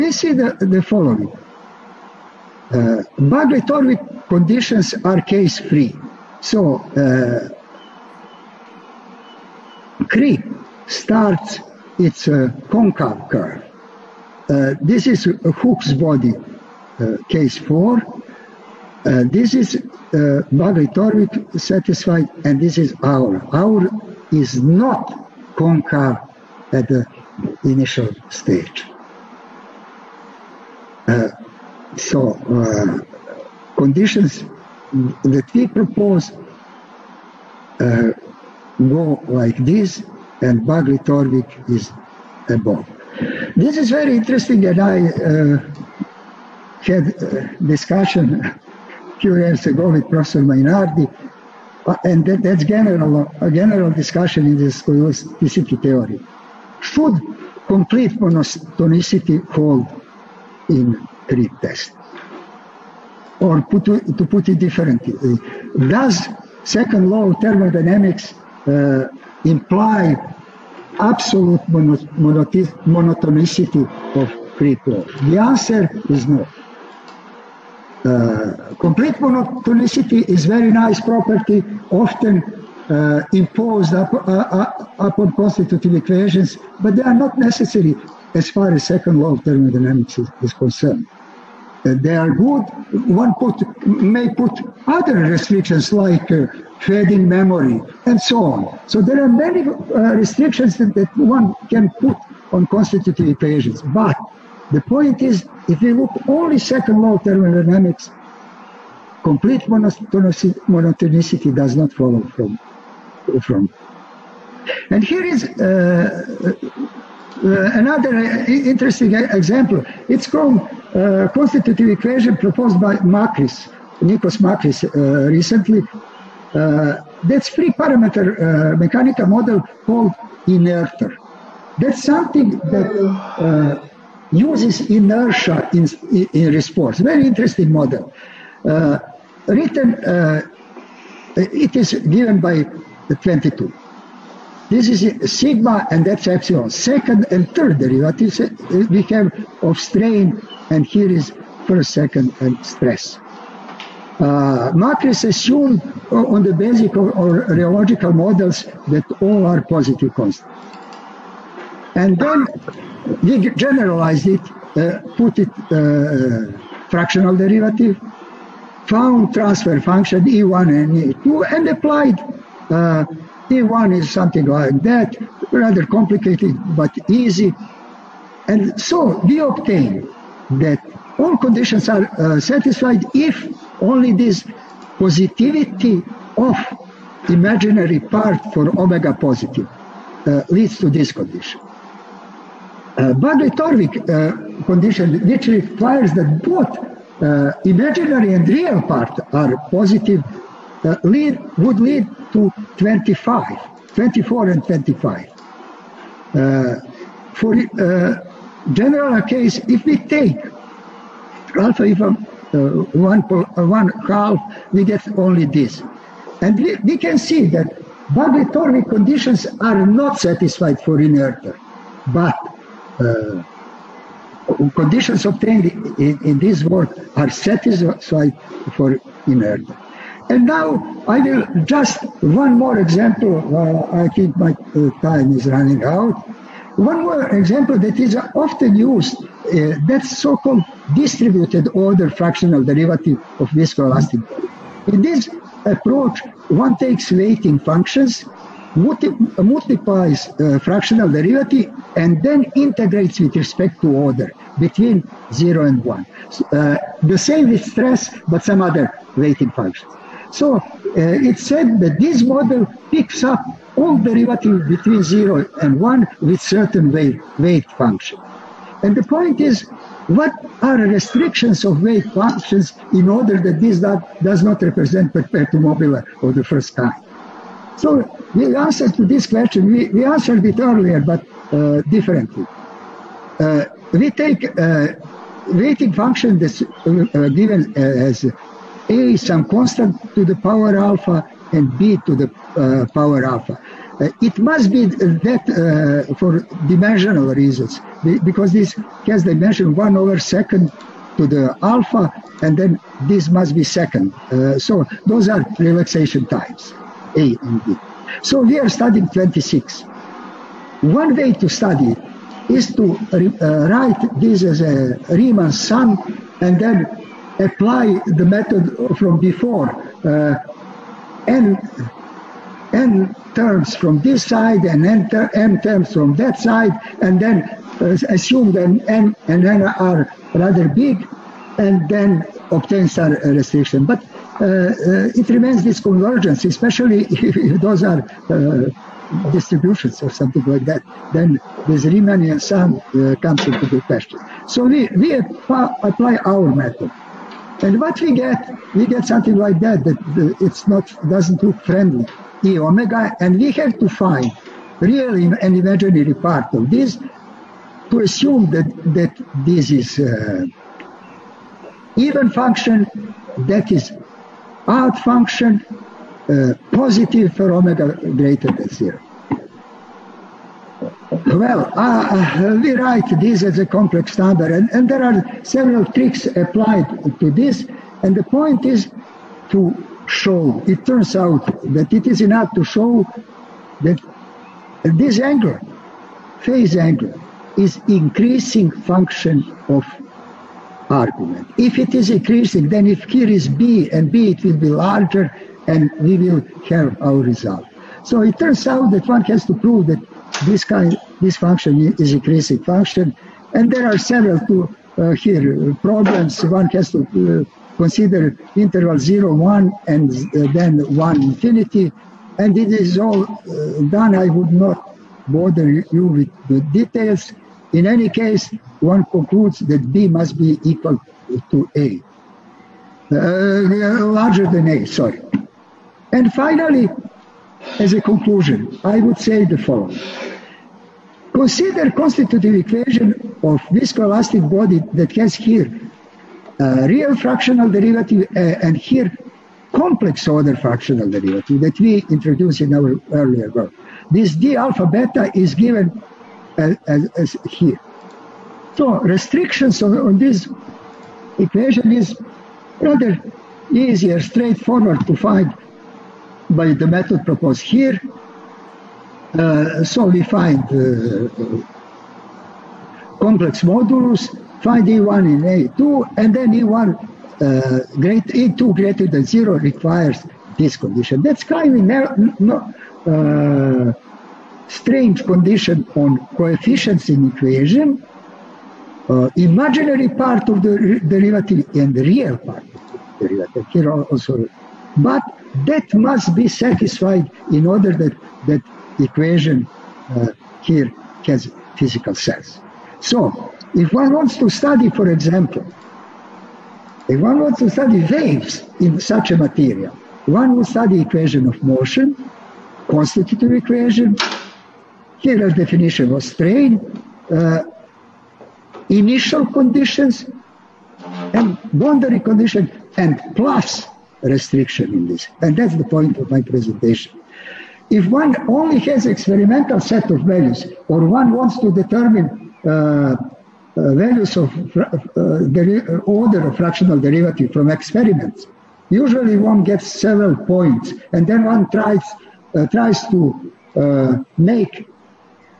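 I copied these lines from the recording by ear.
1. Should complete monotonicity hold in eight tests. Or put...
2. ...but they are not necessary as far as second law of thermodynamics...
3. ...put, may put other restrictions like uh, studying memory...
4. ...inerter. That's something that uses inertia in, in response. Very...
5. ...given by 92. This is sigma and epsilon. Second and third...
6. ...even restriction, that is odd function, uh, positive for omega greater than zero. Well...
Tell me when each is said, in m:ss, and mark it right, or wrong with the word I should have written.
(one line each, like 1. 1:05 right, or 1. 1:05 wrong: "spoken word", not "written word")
1. 0:56 wrong: "three", not "eight"
2. 1:26 right
3. 1:33 wrong: "fading", not "studying"
4. 2:10 right
5. 2:21 wrong: "22", not "92"
6. 6:01 wrong: "function", not "restriction".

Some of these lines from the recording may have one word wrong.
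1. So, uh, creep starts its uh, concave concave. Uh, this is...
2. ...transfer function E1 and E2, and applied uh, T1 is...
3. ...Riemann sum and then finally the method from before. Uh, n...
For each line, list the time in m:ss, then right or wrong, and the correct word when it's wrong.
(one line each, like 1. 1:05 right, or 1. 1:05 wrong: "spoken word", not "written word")
1. 0:06 wrong: "curve", not "concave"
2. 2:49 right
3. 5:15 wrong: "apply", not "finally".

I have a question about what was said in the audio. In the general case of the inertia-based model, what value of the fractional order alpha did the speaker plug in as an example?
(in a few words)
1/2.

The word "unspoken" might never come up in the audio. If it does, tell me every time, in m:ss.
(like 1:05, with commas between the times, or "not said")
not said.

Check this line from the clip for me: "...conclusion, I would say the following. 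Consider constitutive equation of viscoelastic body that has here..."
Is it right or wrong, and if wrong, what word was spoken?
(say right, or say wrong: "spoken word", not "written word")
right.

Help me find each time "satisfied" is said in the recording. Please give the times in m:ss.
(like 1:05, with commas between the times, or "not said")
0:21, 3:02, 3:40, 3:47, 8:06.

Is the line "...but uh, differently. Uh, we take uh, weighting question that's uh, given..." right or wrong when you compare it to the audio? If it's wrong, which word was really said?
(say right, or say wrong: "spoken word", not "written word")
wrong: "function", not "question".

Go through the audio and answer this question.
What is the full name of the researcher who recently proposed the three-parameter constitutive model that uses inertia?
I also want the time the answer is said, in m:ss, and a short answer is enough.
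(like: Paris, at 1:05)
Nikos Makris, at 2:04.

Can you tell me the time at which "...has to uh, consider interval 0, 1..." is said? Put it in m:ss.
6:46.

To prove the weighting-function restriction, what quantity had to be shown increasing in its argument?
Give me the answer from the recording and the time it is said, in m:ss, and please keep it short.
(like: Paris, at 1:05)
phase angle, at 6:26.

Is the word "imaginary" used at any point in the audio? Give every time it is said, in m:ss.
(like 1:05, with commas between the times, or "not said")
3:07, 3:17, 5:55, 7:59.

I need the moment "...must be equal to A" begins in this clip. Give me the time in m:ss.
7:00.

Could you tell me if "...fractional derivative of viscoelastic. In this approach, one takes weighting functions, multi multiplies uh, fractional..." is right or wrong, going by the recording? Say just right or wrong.
right.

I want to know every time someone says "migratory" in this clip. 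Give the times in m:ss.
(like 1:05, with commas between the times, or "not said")
0:03, 0:20.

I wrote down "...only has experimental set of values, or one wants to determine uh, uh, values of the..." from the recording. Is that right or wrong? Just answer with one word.
right.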